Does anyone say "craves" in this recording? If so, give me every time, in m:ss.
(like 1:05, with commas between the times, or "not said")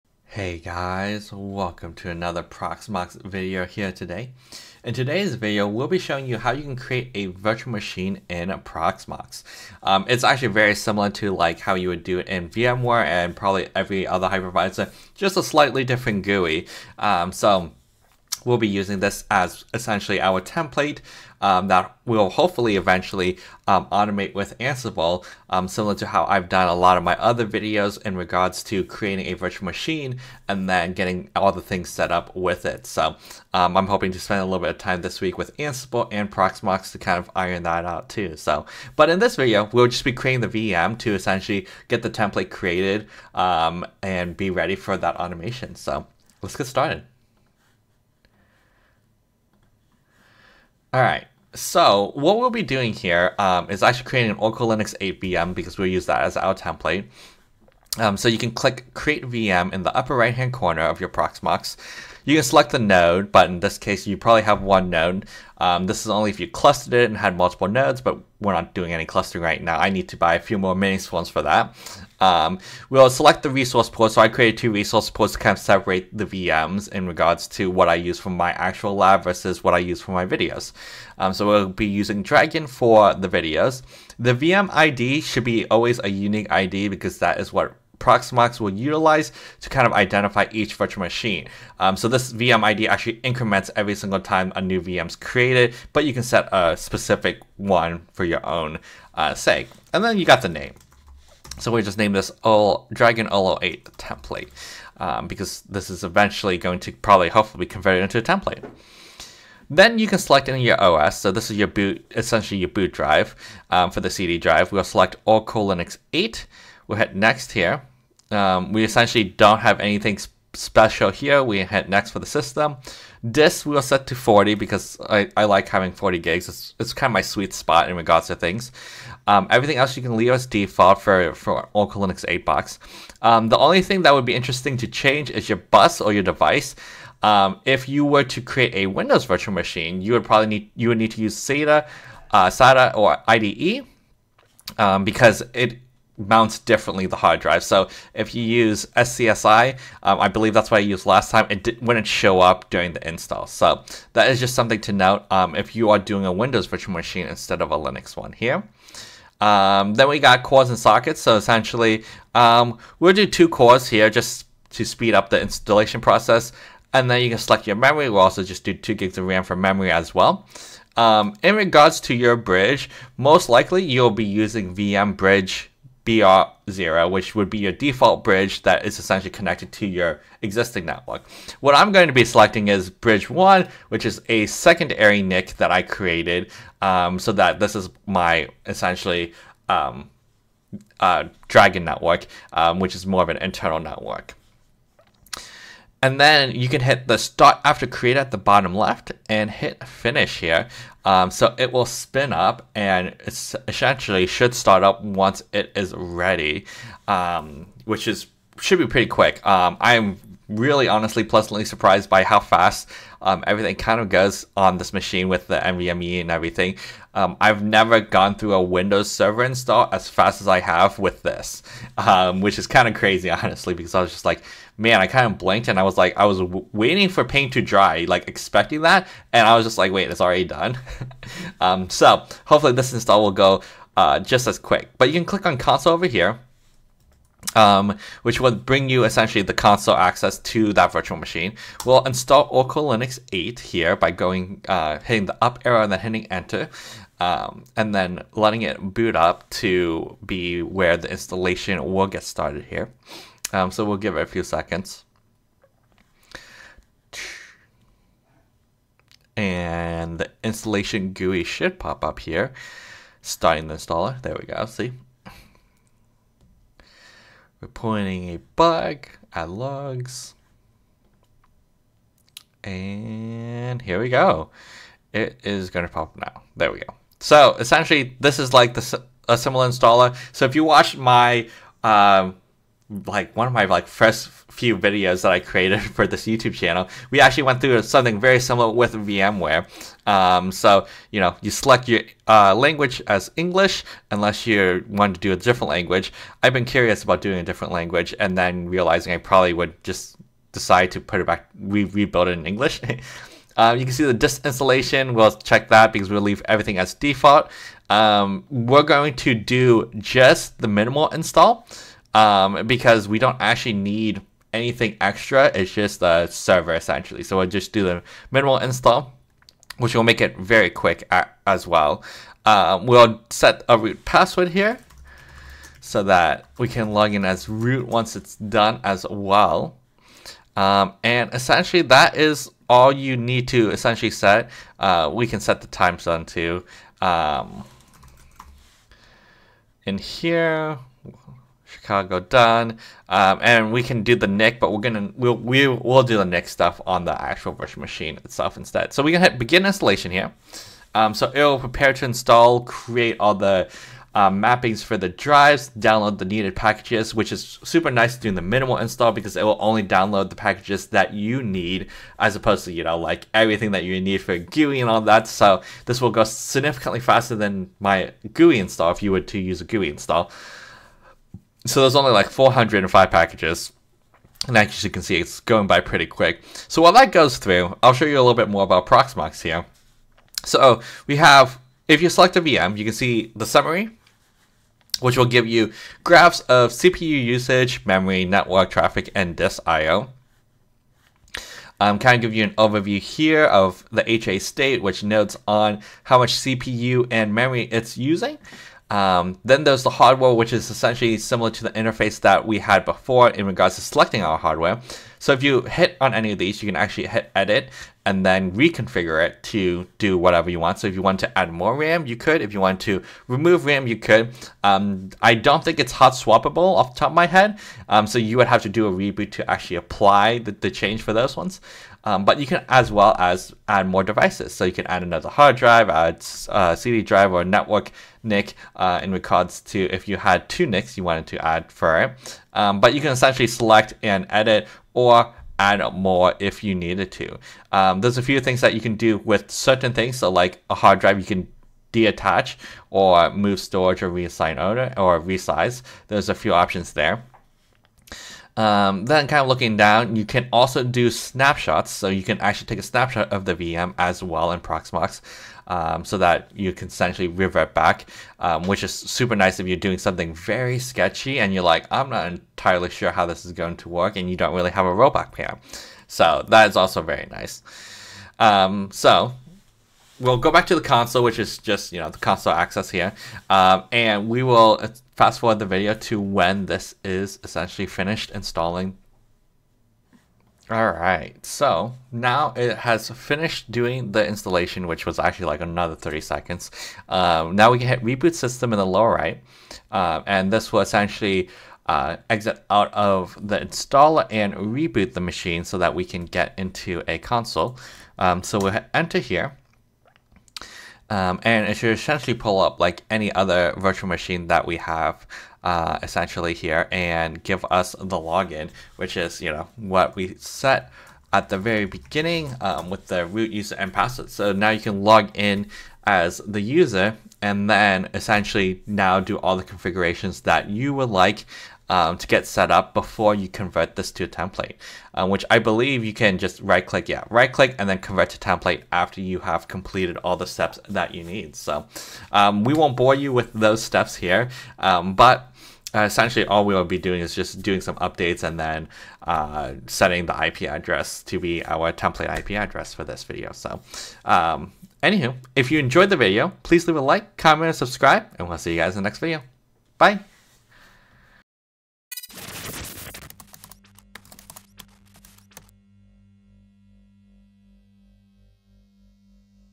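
not said.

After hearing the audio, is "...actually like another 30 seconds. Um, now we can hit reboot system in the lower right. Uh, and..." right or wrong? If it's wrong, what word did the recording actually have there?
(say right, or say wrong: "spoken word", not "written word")
right.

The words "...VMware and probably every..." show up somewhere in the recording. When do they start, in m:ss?
0:12.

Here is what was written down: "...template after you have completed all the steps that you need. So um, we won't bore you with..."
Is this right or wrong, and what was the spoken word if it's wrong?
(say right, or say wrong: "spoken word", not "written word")
right.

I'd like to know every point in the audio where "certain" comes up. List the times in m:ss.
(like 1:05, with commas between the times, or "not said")
7:19.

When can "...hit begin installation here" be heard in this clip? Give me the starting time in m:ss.
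5:49.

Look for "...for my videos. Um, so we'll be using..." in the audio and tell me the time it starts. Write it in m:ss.
1:20.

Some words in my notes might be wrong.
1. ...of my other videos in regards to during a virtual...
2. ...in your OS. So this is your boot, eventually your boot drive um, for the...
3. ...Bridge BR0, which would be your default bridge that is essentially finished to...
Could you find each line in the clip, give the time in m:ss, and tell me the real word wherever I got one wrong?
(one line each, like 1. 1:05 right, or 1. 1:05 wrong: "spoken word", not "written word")
1. 0:26 wrong: "creating", not "during"
2. 1:50 wrong: "essentially", not "eventually"
3. 2:55 wrong: "connected", not "finished".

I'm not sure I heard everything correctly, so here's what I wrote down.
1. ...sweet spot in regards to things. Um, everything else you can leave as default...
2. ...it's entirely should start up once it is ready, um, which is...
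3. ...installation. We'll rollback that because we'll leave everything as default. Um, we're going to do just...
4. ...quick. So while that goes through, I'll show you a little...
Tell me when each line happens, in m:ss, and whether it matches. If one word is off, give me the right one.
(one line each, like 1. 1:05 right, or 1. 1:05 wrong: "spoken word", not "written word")
1. 2:07 right
2. 3:23 wrong: "essentially", not "entirely"
3. 5:04 wrong: "check", not "rollback"
4. 6:16 right.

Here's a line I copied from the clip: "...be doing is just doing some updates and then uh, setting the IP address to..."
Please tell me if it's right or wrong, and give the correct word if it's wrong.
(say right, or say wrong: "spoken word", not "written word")
right.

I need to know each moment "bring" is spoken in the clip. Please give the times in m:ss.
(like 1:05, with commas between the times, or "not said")
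3:58.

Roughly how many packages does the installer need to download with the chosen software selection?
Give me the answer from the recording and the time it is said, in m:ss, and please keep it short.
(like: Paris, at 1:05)
405, at 6:12.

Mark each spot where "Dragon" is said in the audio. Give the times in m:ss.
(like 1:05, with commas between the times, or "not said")
1:22, 1:42, 3:11.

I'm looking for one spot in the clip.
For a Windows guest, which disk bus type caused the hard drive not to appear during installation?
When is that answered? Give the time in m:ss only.
2:28.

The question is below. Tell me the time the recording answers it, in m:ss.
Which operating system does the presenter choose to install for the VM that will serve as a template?
0:54.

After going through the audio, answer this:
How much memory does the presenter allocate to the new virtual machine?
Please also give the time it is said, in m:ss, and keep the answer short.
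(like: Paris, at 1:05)
2 gigs, at 2:48.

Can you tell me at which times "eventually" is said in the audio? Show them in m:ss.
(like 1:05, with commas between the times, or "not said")
0:22, 1:46.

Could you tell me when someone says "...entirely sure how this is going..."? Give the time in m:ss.
7:42.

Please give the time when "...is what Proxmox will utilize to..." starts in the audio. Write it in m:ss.
1:27.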